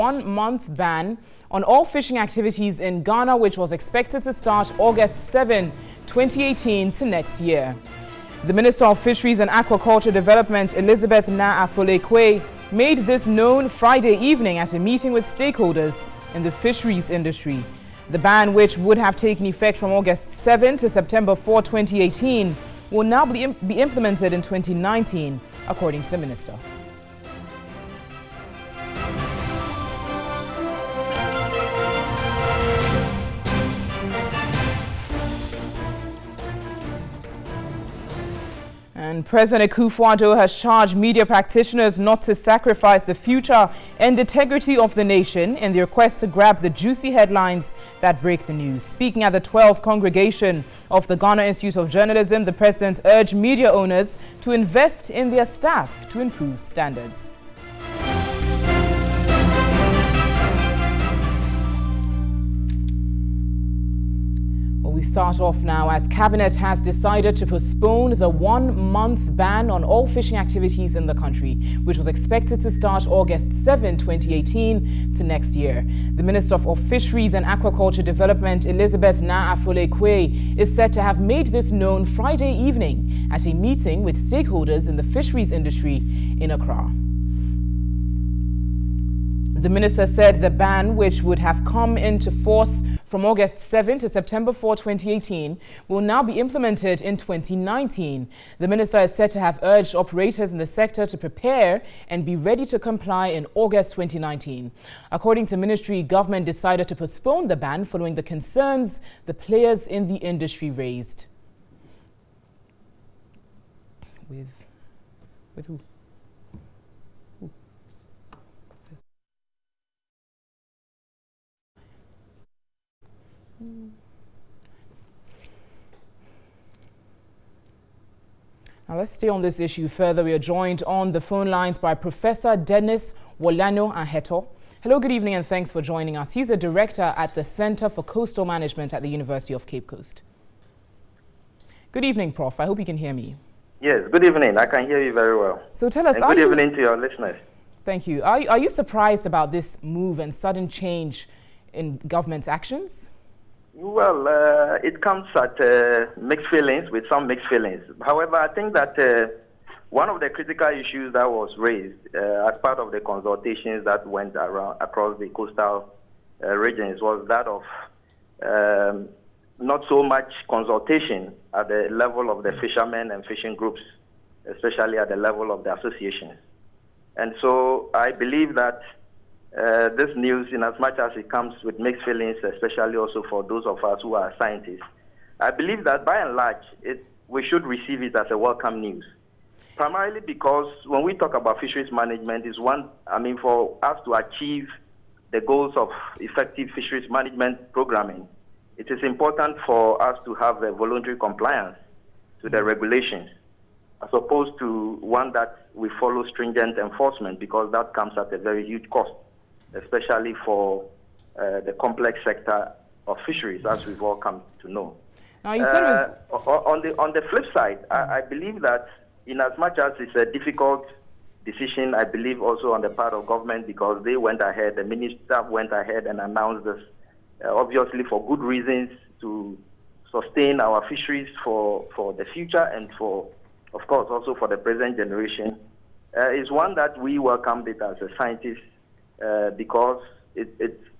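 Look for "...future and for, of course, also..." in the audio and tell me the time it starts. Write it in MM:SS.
03:52.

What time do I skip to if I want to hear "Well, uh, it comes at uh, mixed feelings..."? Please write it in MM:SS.
02:33.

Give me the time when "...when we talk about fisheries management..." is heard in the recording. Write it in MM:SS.
03:10.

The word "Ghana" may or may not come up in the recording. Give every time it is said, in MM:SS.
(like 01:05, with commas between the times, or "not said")
00:03, 00:51.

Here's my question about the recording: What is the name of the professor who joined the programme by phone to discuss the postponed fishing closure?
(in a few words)
Dennis Worlanyo Aheto.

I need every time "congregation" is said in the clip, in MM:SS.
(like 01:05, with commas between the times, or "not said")
00:49.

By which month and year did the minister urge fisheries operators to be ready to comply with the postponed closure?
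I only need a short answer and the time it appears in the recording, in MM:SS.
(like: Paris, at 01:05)
August 2019, at 01:43.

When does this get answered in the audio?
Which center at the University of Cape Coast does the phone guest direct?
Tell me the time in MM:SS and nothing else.
02:17.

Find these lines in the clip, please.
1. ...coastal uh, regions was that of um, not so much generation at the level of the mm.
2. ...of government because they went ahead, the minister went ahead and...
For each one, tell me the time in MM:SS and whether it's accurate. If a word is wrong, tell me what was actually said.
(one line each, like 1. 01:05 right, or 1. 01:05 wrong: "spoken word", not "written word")
1. 02:45 wrong: "consultation", not "generation"
2. 03:43 right.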